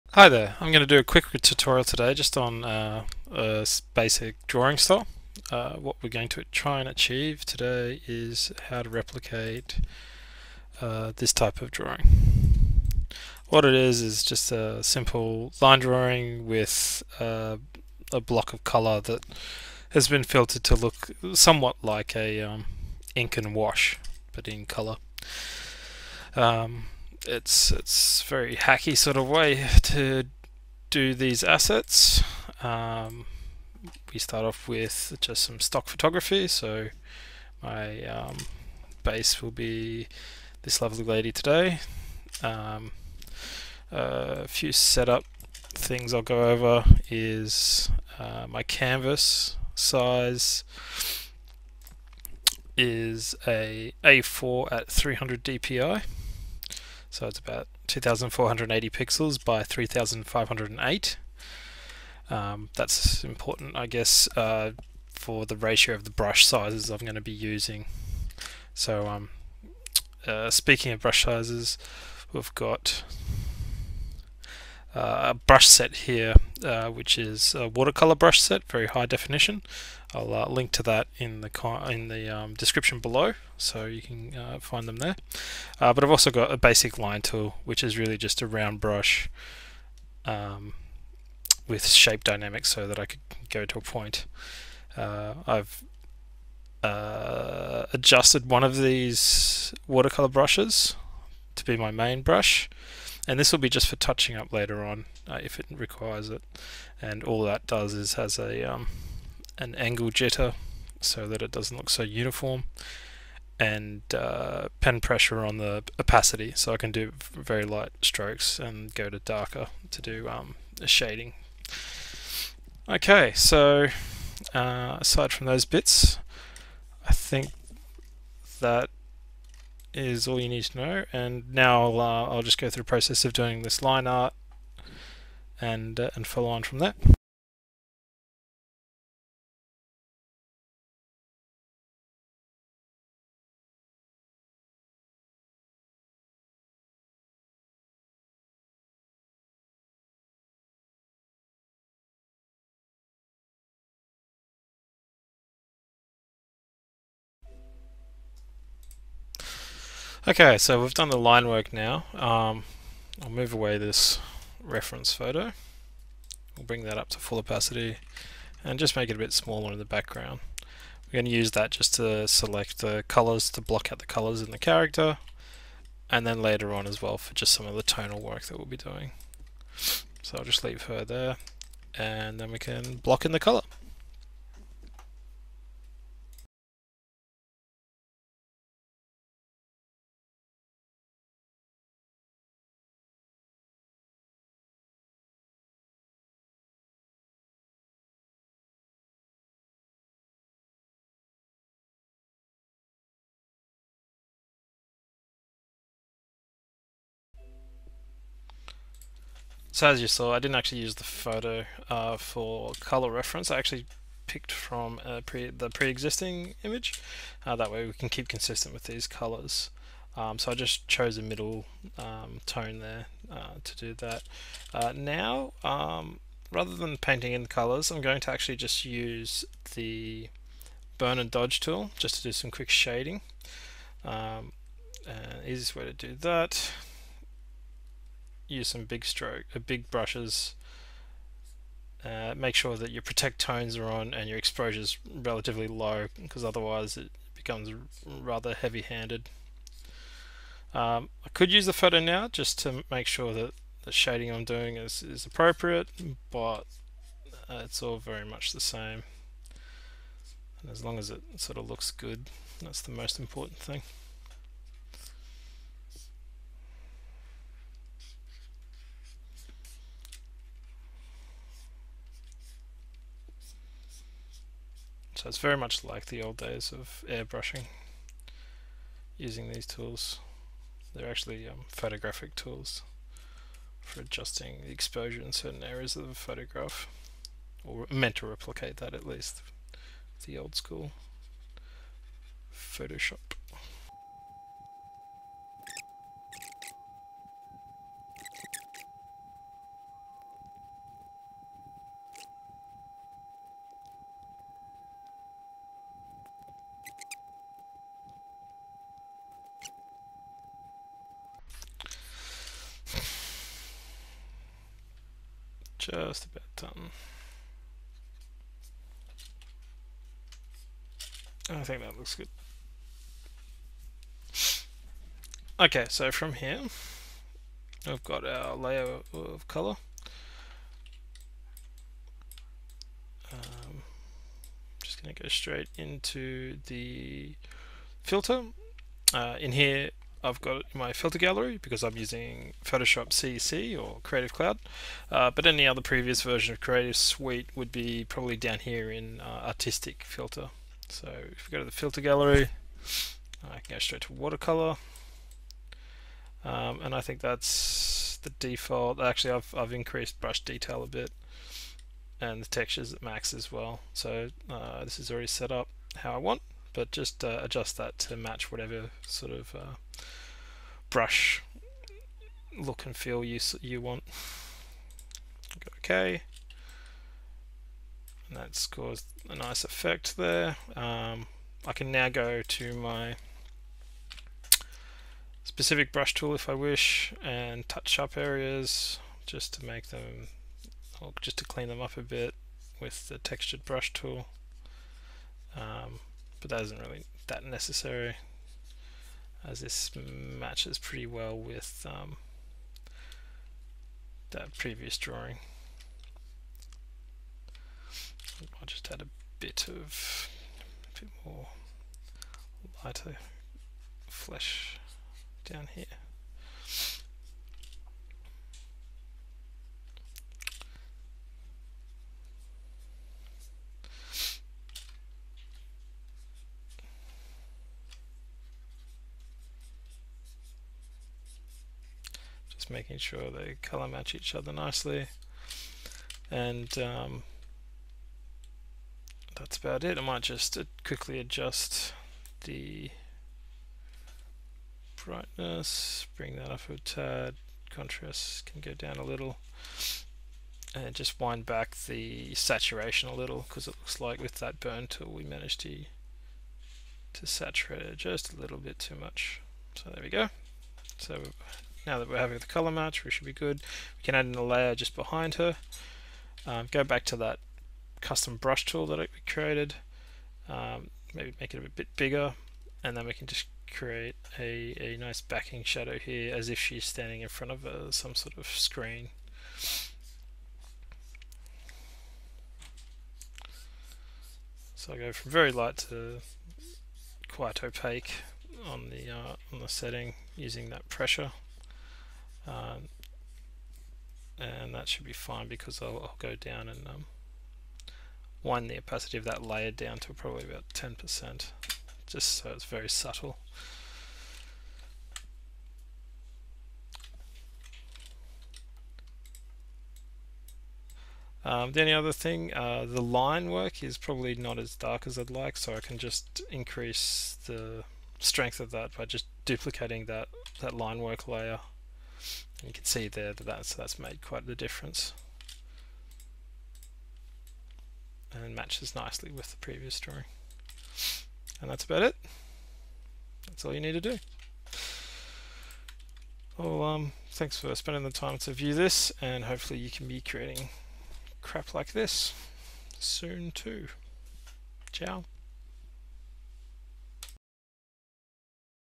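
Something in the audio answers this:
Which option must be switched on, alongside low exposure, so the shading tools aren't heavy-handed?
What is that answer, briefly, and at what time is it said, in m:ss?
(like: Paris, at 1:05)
protect tones, at 4:03.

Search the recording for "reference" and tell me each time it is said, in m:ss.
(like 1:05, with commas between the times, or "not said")
2:44, 3:33.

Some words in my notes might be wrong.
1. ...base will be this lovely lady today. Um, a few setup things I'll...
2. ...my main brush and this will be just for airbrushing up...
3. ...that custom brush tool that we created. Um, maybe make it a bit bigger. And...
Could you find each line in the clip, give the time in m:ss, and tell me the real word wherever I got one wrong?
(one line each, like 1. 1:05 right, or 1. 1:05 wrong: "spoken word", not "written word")
1. 0:39 right
2. 1:41 wrong: "touching", not "airbrushing"
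3. 7:47 right.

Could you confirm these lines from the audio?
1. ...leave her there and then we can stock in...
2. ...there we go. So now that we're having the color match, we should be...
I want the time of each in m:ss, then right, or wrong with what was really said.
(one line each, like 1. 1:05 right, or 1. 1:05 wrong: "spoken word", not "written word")
1. 3:00 wrong: "block", not "stock"
2. 7:39 right.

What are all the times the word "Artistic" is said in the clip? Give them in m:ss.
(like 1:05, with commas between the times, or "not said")
5:49.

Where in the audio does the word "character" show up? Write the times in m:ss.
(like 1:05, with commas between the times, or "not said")
2:54.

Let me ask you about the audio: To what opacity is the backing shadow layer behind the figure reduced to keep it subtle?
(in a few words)
10%.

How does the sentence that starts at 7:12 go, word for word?
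making sure they color match each other nicely and um, that's about it.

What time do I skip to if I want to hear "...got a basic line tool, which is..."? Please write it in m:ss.
1:26.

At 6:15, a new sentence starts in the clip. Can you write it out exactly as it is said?
okay, and that's caused a nice effect there.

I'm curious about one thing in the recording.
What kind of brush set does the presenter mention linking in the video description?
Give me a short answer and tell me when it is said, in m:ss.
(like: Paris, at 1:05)
watercolor brush set, at 1:17.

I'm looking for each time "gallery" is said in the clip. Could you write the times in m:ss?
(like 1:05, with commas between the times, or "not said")
5:41, 5:52.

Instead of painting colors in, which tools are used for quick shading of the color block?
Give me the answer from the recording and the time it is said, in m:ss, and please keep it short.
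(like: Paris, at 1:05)
burn and dodge, at 3:50.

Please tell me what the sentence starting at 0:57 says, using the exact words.
So it's about 2480 pixels by 3508.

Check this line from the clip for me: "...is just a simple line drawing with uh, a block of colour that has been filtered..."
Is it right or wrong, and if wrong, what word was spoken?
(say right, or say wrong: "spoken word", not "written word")
right.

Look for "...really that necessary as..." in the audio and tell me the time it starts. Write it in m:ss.
6:36.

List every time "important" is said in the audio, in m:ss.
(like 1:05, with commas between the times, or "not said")
1:03, 4:23.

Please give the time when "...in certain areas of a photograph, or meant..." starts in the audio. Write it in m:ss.
4:45.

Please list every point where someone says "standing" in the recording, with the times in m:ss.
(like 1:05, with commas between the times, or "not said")
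7:56.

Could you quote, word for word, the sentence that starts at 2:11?
And now I'll, uh, I'll just go through the process of doing this line art and, uh, and follow on from that.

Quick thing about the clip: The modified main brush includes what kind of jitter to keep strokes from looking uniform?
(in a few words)
angle jitter.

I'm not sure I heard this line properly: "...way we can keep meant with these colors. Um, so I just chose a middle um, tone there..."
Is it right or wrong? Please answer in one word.
wrong.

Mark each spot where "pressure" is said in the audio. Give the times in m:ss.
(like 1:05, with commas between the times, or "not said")
1:54, 8:10.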